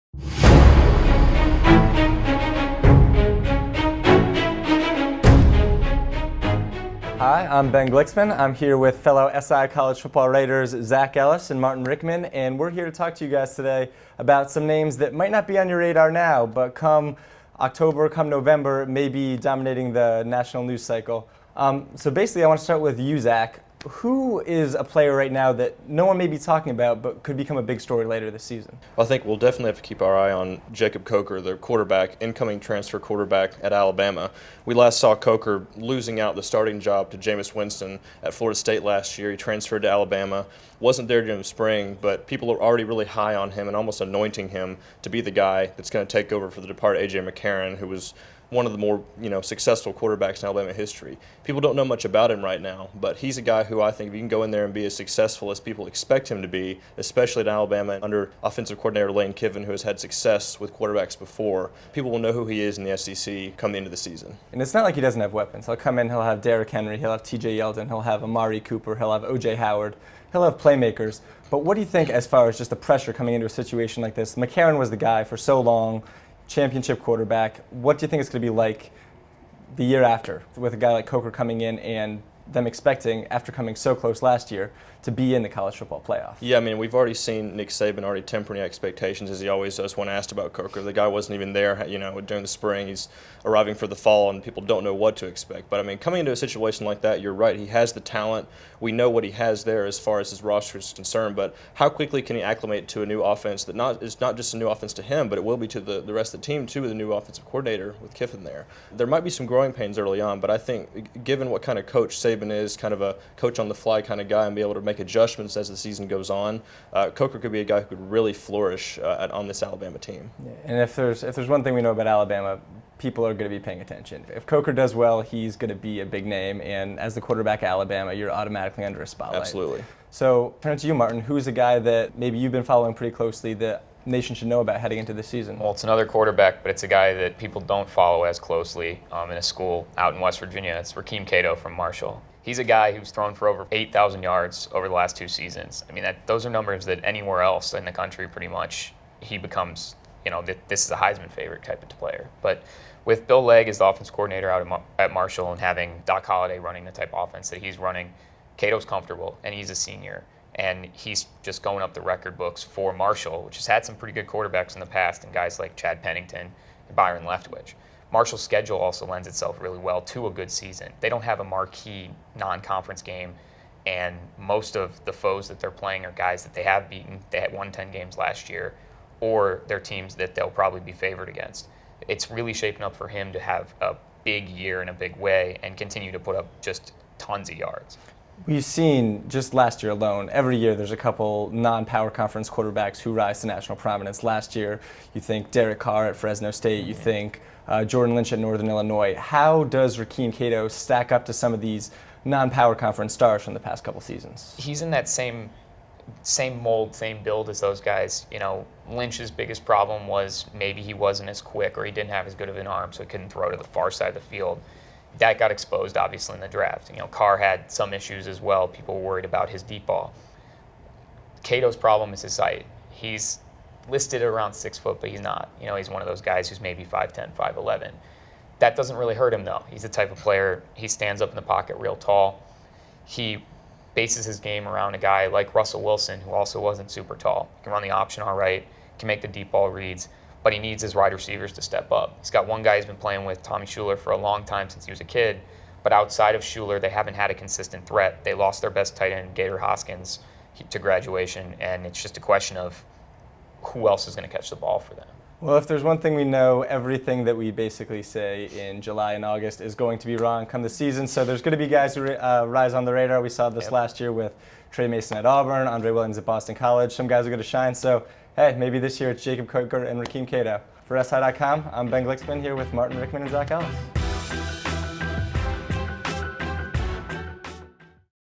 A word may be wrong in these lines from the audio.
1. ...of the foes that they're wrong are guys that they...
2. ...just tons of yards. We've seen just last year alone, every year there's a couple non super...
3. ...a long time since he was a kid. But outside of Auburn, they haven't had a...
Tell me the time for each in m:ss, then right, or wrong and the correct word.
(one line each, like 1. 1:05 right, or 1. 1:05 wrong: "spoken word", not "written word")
1. 2:54 wrong: "playing", not "wrong"
2. 3:06 wrong: "power", not "super"
3. 4:04 wrong: "Shuler", not "Auburn".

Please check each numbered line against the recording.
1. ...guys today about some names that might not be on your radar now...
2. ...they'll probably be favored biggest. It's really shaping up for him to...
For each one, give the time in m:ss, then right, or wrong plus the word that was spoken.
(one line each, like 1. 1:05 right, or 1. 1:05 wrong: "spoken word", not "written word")
1. 0:13 right
2. 3:00 wrong: "against", not "biggest".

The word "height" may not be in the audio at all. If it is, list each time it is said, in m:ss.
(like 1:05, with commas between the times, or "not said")
3:42.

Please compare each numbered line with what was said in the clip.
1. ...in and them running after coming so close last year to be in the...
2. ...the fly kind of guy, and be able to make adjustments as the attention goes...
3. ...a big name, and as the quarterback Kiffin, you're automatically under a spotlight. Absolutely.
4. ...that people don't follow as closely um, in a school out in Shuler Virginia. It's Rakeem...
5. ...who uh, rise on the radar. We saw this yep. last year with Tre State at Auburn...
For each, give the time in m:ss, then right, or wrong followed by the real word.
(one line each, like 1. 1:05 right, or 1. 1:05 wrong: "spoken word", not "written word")
1. 1:21 wrong: "expecting", not "running"
2. 1:53 wrong: "season", not "attention"
3. 2:06 wrong: "Alabama", not "Kiffin"
4. 2:17 wrong: "West", not "Shuler"
5. 4:21 wrong: "Mason", not "State".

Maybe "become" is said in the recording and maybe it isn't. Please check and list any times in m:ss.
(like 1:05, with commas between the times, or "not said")
0:27, 2:29.